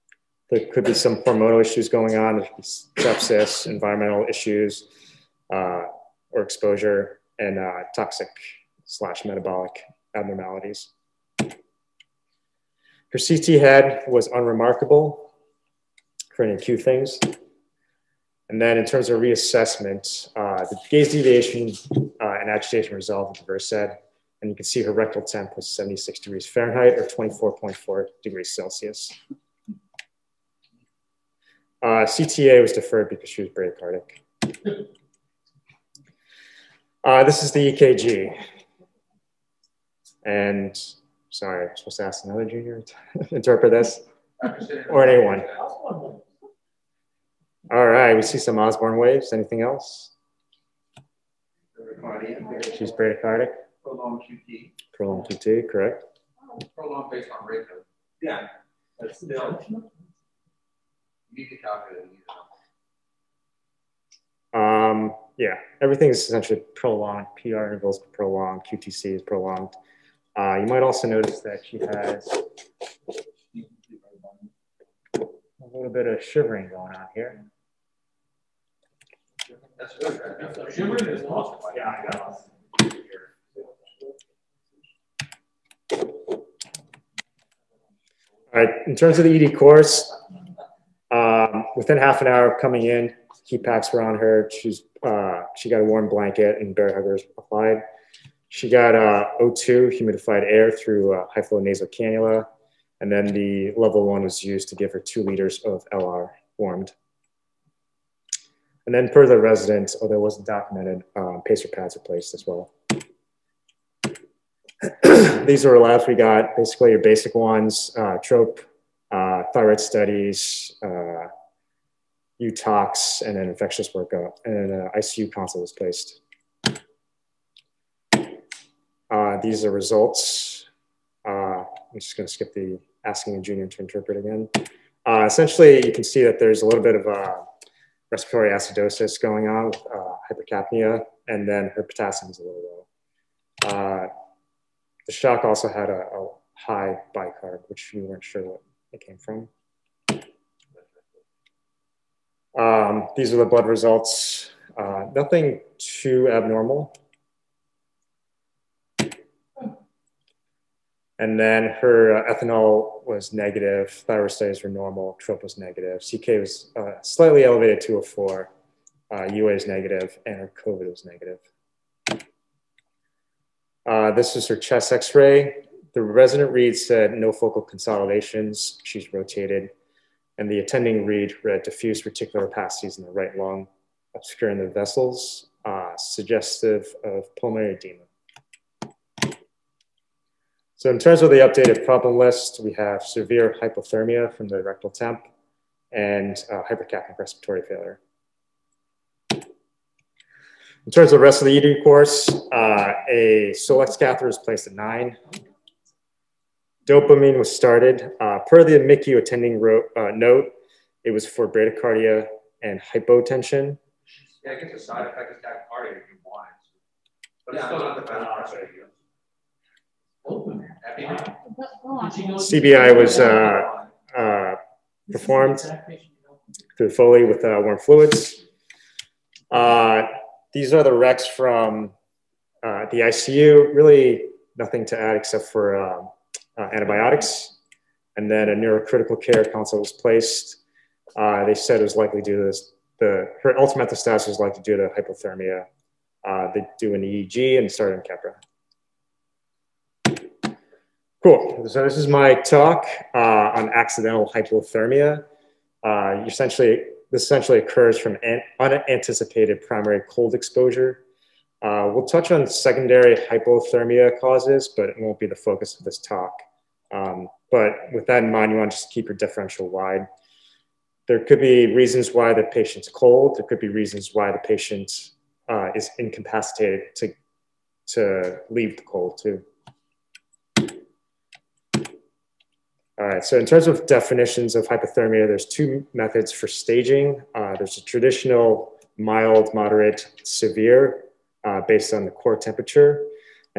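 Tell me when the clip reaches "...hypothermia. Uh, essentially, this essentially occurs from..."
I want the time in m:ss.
4:14.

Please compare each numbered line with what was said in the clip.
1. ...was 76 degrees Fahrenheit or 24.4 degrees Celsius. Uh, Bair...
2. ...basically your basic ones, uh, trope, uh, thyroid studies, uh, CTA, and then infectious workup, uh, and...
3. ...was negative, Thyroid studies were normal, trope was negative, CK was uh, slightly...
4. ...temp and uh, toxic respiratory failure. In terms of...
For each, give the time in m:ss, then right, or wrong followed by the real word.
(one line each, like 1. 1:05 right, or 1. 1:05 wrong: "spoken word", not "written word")
1. 0:25 wrong: "CTA", not "Bair"
2. 1:56 wrong: "UTOX", not "CTA"
3. 2:43 right
4. 3:14 wrong: "hypercapnic", not "toxic".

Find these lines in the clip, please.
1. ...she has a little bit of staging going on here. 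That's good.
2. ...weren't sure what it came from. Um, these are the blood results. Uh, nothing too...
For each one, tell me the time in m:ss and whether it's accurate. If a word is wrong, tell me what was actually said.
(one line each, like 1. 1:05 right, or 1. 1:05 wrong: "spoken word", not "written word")
1. 1:11 wrong: "shivering", not "staging"
2. 2:28 right.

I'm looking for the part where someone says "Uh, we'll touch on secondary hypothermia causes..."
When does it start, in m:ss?
4:21.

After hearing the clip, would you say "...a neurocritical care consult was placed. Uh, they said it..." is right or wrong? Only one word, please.
right.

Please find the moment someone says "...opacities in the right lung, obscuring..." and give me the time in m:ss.
3:02.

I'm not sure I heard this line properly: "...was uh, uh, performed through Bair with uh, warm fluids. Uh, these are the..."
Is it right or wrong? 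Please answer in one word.
wrong.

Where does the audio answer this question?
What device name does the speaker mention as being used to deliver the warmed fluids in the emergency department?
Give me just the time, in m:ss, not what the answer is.
1:43.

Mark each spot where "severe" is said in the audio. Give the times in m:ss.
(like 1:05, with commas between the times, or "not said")
3:13, 4:50.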